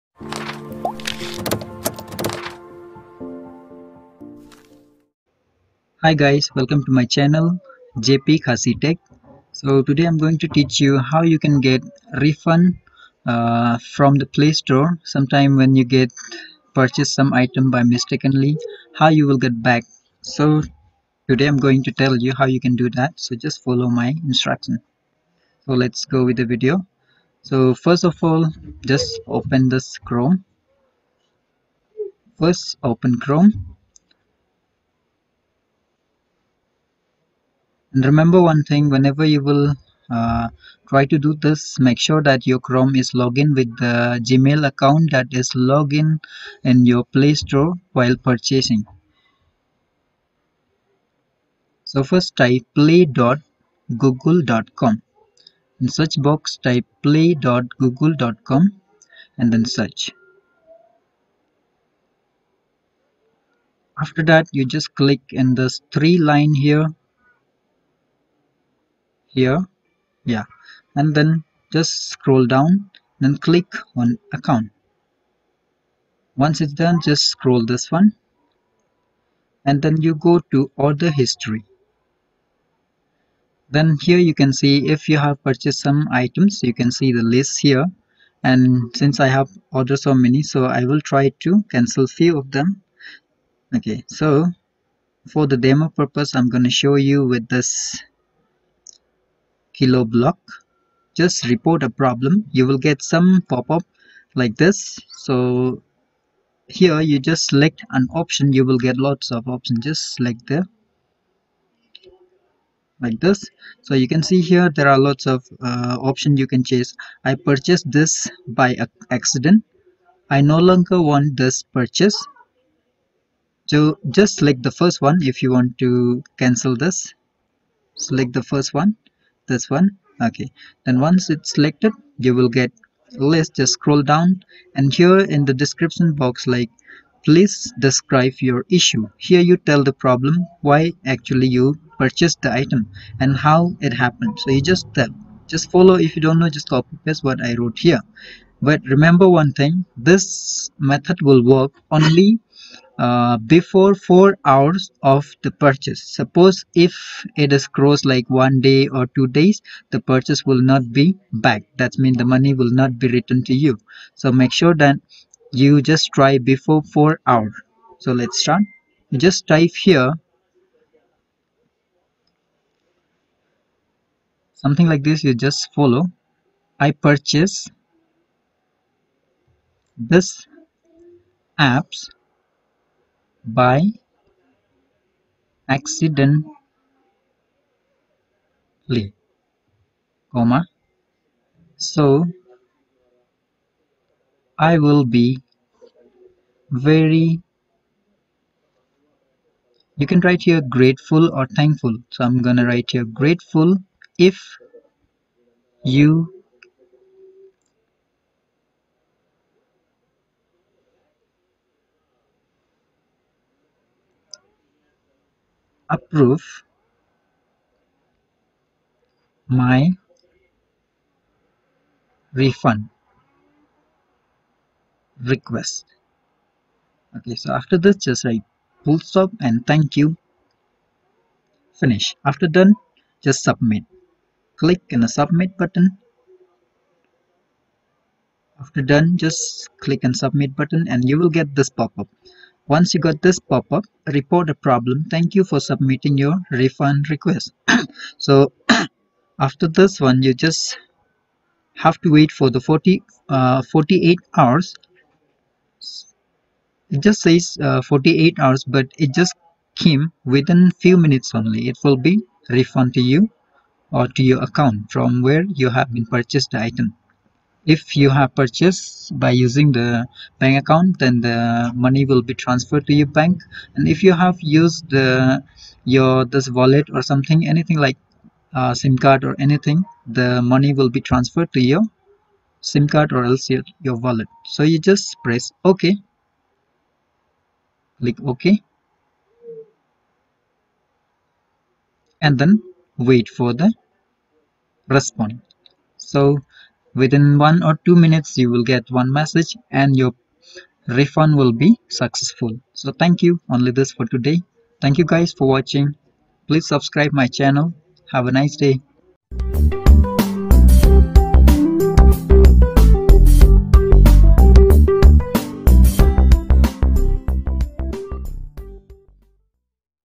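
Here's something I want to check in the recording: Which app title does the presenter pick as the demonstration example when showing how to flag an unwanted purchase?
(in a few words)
Kilo Block.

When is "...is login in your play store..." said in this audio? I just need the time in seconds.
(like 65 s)
45 s.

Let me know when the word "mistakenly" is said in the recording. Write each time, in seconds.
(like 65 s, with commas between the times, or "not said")
17 s.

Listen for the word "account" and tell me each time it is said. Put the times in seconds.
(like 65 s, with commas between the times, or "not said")
44 s, 74 s, 264 s, 270 s.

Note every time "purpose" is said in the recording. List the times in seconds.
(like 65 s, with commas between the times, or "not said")
95 s.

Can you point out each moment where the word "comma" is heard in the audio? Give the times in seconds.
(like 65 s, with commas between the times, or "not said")
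190 s.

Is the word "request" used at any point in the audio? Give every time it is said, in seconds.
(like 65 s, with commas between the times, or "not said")
225 s, 247 s.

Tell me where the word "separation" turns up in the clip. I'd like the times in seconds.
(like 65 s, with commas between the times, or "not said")
not said.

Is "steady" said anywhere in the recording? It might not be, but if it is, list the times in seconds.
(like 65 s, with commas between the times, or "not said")
not said.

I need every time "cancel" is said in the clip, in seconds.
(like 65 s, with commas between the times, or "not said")
91 s, 126 s.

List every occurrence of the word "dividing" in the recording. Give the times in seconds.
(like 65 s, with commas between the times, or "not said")
not said.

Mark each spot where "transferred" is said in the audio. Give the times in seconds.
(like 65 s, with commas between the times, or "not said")
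272 s, 280 s.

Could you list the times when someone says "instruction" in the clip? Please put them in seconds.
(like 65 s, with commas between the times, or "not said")
24 s.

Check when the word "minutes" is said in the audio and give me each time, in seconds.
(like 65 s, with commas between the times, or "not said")
260 s, 297 s.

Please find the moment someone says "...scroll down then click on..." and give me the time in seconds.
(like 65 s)
72 s.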